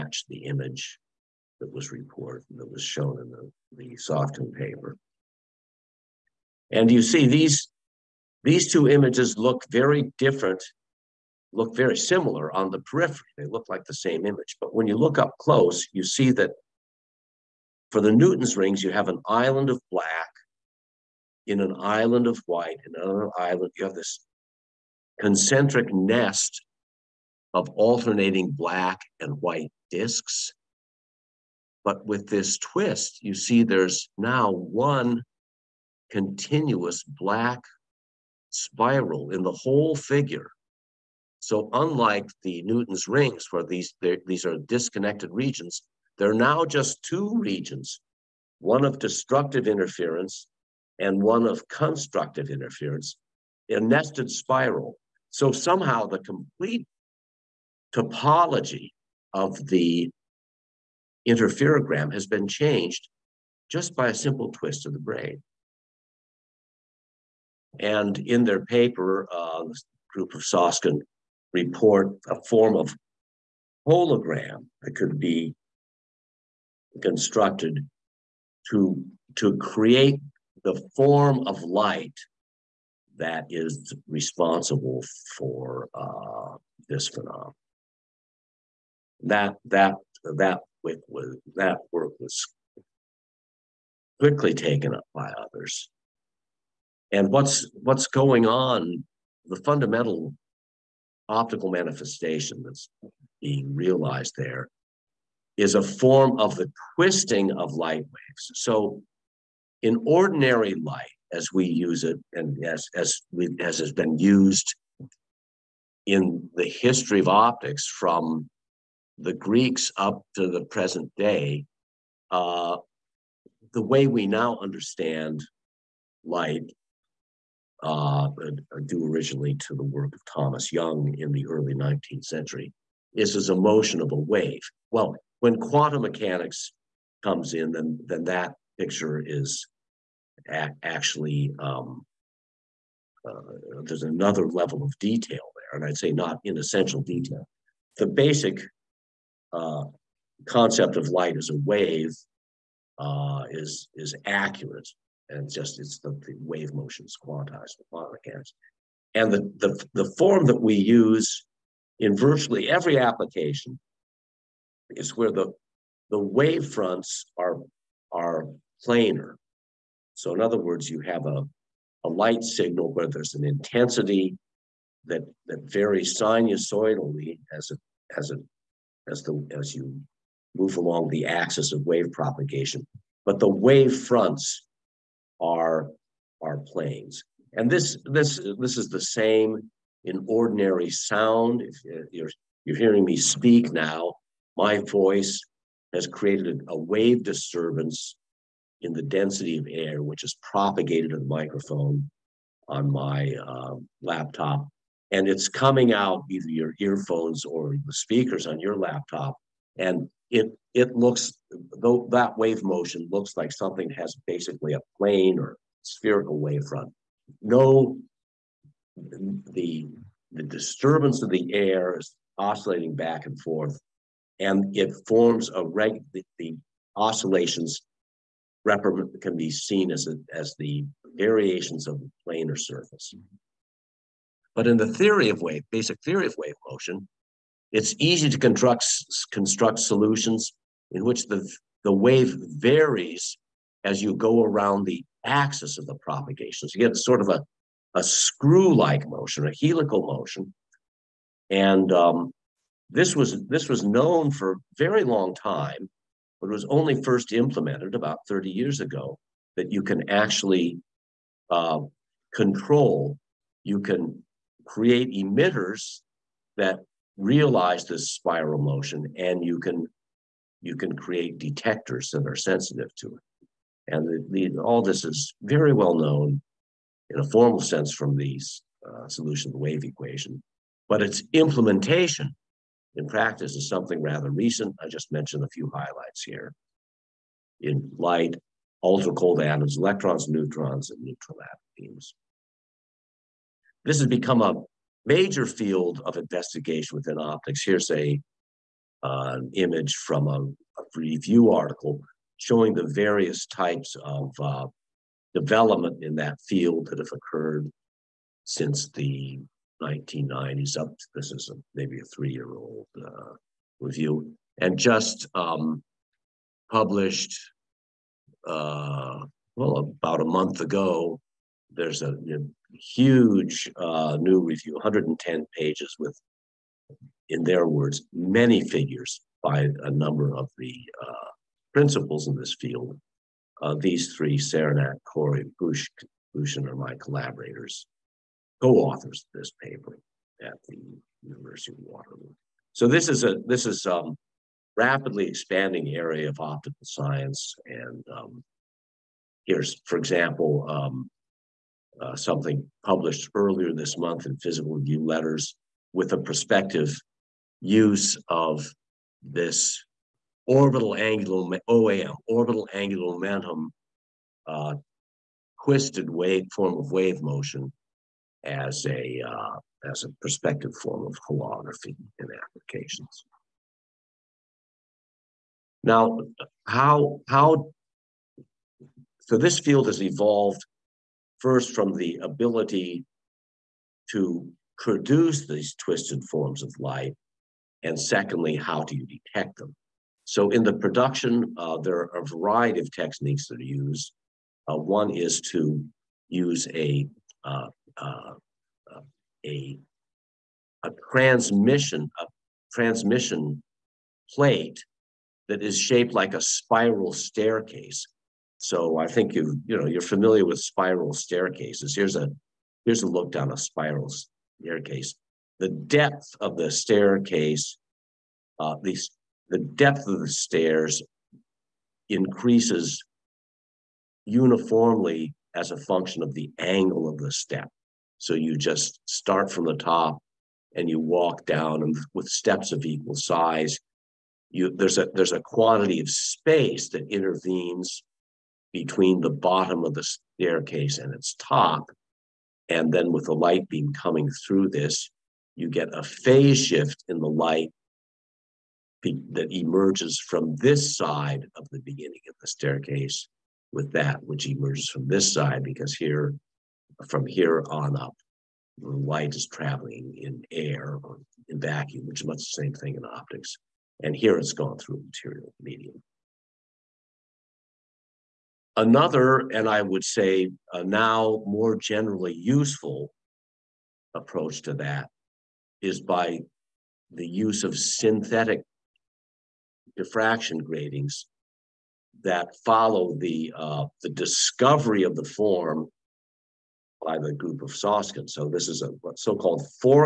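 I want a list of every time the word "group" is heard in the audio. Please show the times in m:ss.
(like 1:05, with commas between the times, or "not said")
1:10, 8:07.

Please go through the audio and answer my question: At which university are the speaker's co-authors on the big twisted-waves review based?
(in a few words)
University of Waterloo.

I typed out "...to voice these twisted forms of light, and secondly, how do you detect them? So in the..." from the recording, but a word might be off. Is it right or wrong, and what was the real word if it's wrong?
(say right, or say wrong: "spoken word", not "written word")
wrong: "produce", not "voice".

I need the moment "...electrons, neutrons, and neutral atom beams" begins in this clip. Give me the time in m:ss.
4:49.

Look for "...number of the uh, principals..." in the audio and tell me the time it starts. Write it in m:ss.
5:29.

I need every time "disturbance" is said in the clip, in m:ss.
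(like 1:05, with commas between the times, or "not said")
3:17, 3:40.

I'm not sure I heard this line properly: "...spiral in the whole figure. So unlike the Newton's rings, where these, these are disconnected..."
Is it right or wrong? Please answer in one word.
right.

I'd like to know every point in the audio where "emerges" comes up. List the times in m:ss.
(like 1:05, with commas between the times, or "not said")
7:29, 7:34.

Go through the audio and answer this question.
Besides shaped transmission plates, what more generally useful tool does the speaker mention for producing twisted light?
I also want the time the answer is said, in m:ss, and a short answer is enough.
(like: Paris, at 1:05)
Synthetic diffraction gratings, at 7:57.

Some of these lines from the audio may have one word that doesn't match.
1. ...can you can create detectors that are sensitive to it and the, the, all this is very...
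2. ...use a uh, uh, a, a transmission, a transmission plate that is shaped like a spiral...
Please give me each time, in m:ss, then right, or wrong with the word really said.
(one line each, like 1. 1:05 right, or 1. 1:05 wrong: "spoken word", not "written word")
1. 4:29 right
2. 6:36 right.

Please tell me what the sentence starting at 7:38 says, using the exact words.
Light is traveling in air or in vacuum, which is much the same thing in optics.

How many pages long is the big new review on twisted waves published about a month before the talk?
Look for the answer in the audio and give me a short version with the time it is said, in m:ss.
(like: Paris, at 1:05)
110, at 5:24.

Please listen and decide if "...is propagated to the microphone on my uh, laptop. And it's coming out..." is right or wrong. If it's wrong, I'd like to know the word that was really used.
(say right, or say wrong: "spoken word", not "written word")
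right.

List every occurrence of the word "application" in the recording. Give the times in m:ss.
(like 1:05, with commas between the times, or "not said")
2:42, 6:12.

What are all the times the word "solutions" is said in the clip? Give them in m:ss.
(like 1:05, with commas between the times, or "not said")
3:59, 4:39.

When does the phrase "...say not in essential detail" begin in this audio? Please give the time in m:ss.
2:25.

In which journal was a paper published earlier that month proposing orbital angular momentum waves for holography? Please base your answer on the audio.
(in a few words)
Physical Review Letters.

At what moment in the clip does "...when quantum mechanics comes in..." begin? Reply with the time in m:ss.
2:15.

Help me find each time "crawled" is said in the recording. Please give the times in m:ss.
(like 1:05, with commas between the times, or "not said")
not said.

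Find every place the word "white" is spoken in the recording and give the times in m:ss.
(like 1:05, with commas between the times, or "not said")
0:22, 0:29.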